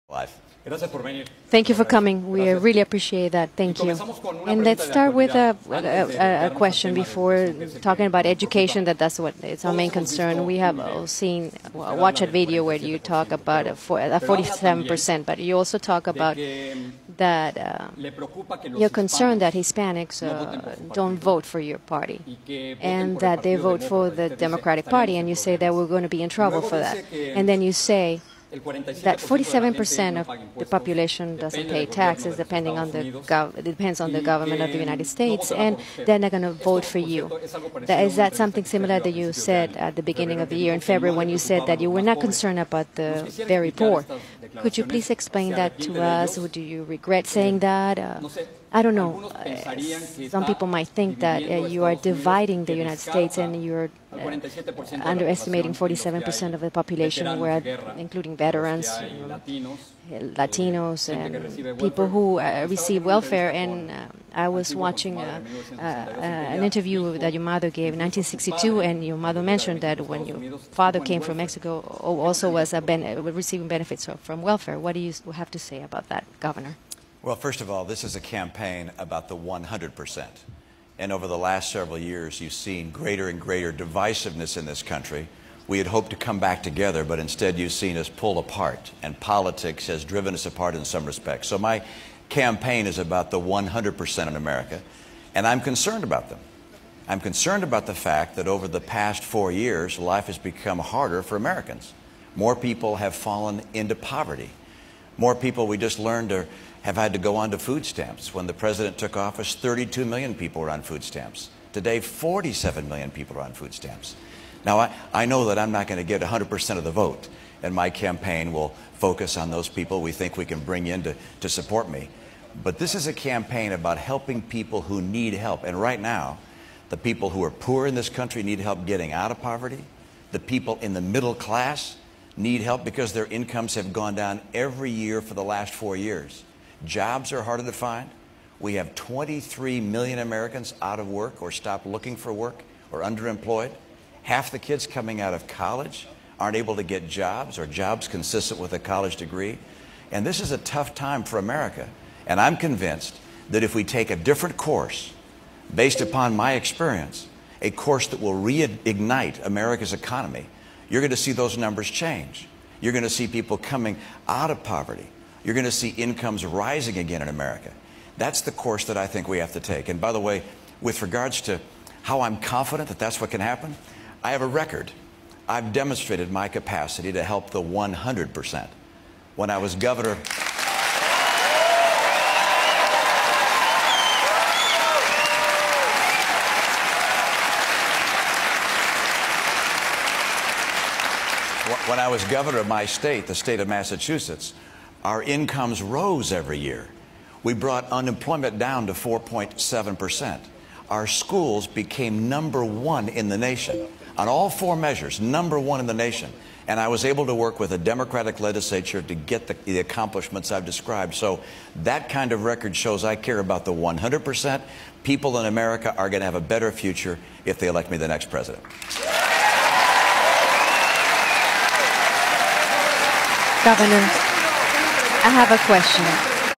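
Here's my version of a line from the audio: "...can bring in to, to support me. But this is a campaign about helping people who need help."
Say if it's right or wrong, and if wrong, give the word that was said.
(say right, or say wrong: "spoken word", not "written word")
right.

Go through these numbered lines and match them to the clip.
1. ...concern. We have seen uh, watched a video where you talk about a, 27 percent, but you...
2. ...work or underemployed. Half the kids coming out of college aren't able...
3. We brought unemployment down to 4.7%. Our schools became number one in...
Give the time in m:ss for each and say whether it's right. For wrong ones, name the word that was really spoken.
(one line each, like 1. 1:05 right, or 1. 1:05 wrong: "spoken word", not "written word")
1. 0:09 wrong: "47", not "27"
2. 2:22 right
3. 3:17 right.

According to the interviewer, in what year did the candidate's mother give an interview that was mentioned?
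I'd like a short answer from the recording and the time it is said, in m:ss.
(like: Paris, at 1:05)
1962, at 1:07.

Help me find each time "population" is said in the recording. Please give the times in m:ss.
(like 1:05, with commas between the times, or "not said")
0:30, 0:56.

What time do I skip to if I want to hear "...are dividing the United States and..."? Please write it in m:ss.
0:51.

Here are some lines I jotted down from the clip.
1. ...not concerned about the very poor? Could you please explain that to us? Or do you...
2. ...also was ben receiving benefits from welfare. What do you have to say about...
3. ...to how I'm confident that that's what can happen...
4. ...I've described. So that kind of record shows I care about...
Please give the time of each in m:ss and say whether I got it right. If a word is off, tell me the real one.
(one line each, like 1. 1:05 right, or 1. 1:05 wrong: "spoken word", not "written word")
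1. 0:42 right
2. 1:12 right
3. 2:51 right
4. 3:30 right.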